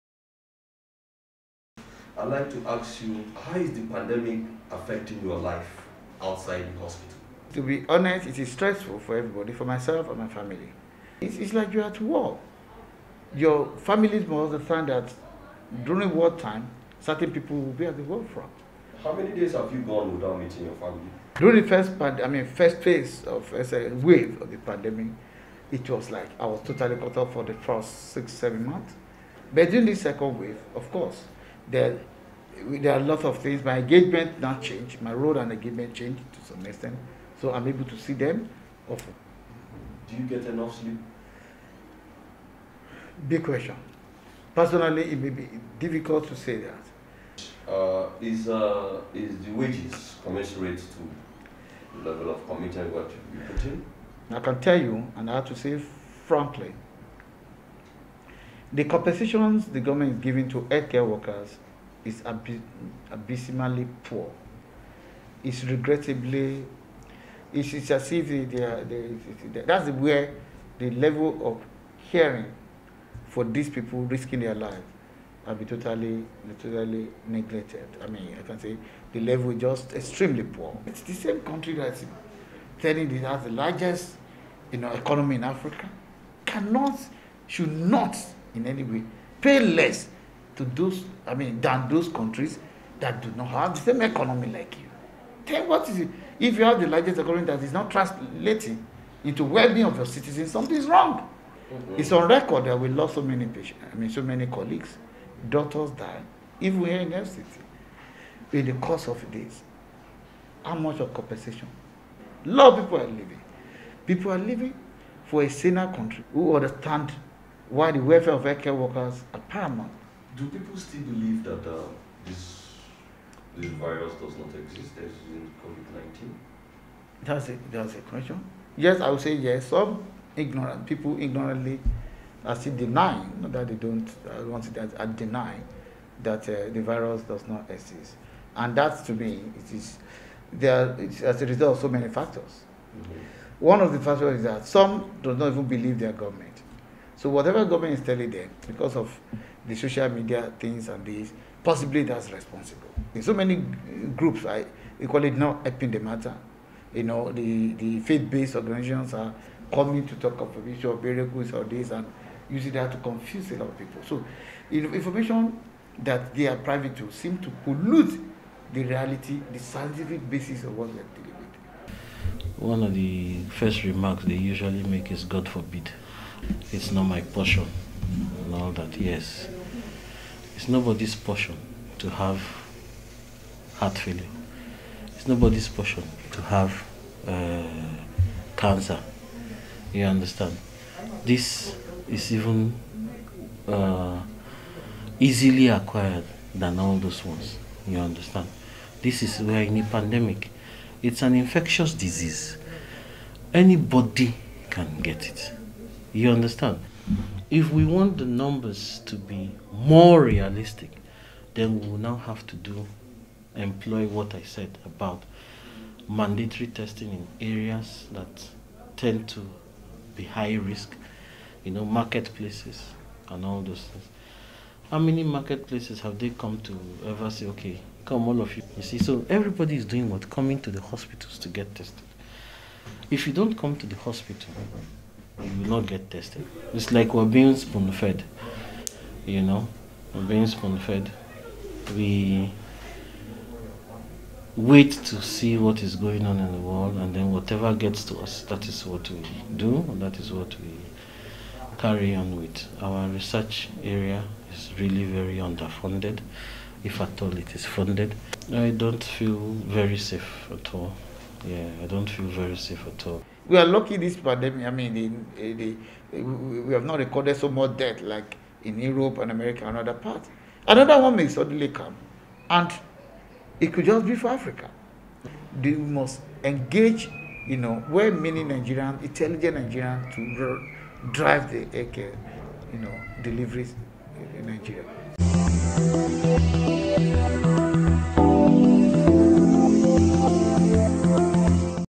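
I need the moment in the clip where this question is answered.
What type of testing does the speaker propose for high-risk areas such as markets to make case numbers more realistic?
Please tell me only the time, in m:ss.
3:36.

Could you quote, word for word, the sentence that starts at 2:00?
Do people still believe that uh, this, this virus does not exist as in COVID 19?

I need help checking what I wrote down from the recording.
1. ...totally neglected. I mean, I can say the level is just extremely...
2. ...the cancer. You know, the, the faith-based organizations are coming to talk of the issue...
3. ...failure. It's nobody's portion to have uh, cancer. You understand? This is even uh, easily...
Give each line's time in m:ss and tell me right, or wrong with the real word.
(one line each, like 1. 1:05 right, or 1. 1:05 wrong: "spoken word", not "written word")
1. 1:16 right
2. 2:35 wrong: "matter", not "cancer"
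3. 3:03 right.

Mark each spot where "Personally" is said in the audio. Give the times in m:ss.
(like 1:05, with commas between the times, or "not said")
0:44.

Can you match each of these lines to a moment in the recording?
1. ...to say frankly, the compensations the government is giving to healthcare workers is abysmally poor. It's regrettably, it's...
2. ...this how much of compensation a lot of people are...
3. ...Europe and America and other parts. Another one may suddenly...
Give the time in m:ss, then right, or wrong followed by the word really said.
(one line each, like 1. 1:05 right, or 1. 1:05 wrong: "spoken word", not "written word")
1. 0:55 right
2. 1:49 right
3. 4:28 right.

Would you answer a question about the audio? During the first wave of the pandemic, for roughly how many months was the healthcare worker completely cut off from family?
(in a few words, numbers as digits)
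6-7 months.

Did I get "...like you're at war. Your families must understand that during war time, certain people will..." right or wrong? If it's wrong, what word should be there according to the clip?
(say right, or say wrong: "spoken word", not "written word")
right.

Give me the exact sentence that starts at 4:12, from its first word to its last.
Our research area is really very underfunded, if at all it is funded.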